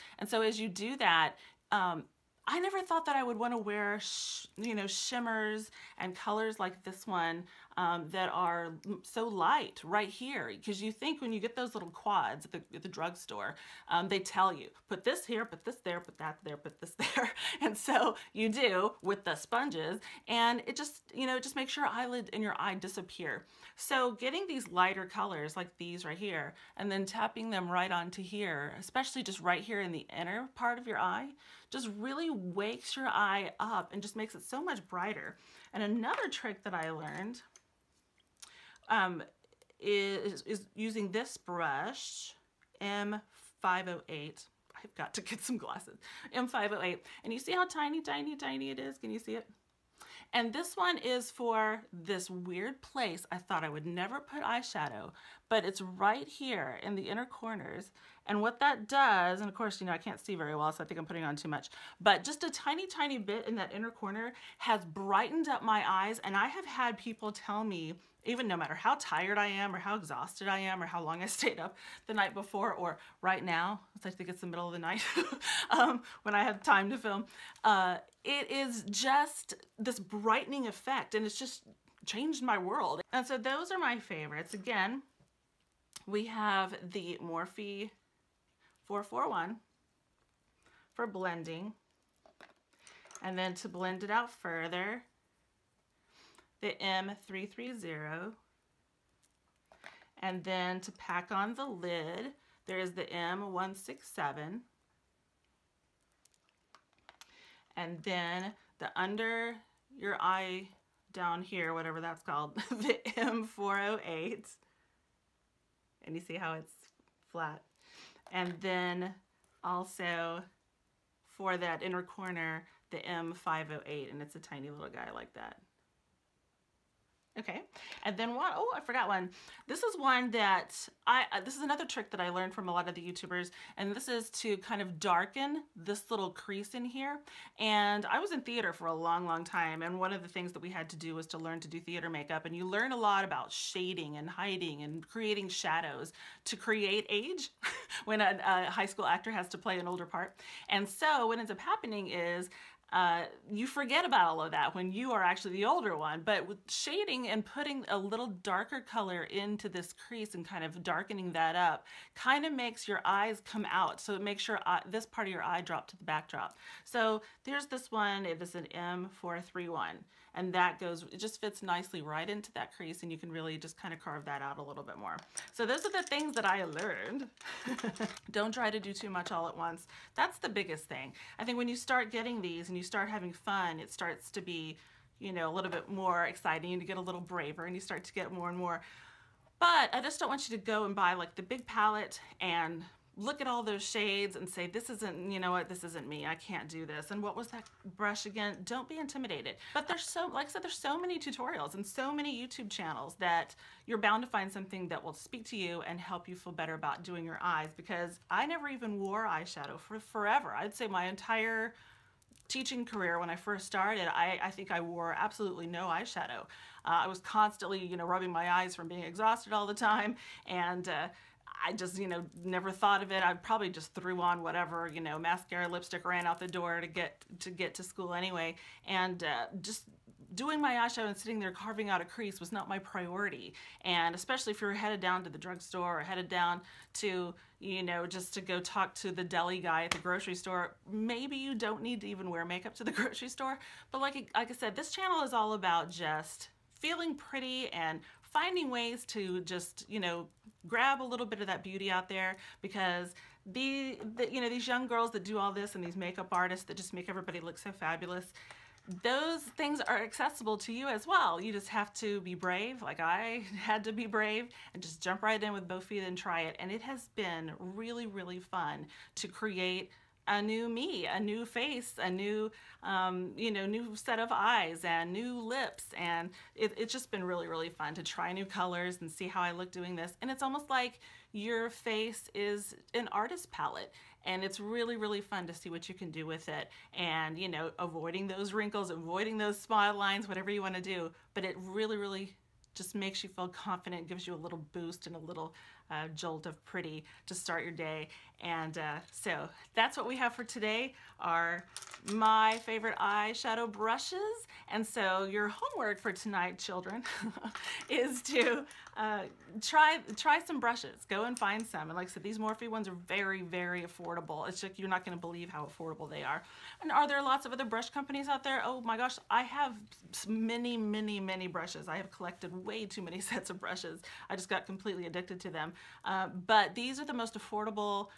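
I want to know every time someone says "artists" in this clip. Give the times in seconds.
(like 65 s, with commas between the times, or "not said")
256 s, 283 s.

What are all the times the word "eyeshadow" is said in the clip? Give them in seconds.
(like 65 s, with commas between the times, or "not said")
54 s, 209 s, 215 s, 230 s, 302 s.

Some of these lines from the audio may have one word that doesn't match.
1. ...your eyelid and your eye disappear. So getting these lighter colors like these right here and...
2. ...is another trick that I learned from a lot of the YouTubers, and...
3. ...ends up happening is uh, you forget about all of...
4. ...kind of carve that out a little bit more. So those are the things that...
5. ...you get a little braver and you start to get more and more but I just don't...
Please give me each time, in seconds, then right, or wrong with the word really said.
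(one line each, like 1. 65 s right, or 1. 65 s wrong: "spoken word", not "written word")
1. 21 s right
2. 131 s right
3. 151 s right
4. 173 s right
5. 186 s right.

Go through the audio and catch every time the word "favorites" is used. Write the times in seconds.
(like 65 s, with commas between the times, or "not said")
83 s, 302 s.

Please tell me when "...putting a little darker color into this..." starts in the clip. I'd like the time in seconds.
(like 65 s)
157 s.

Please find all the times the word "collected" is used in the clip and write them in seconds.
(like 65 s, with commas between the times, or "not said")
322 s.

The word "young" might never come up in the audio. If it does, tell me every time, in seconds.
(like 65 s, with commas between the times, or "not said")
254 s.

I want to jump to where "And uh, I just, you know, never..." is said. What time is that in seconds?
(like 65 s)
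220 s.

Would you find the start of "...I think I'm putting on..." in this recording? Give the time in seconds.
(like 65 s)
60 s.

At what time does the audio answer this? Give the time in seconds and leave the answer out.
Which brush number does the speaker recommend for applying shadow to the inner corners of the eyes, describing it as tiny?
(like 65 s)
42 s.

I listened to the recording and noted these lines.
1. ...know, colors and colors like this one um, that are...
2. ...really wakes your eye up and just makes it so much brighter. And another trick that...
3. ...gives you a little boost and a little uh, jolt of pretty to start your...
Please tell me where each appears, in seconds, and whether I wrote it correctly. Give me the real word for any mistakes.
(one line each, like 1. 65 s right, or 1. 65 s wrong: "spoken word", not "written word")
1. 4 s wrong: "shimmers", not "colors"
2. 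31 s right
3. 294 s right.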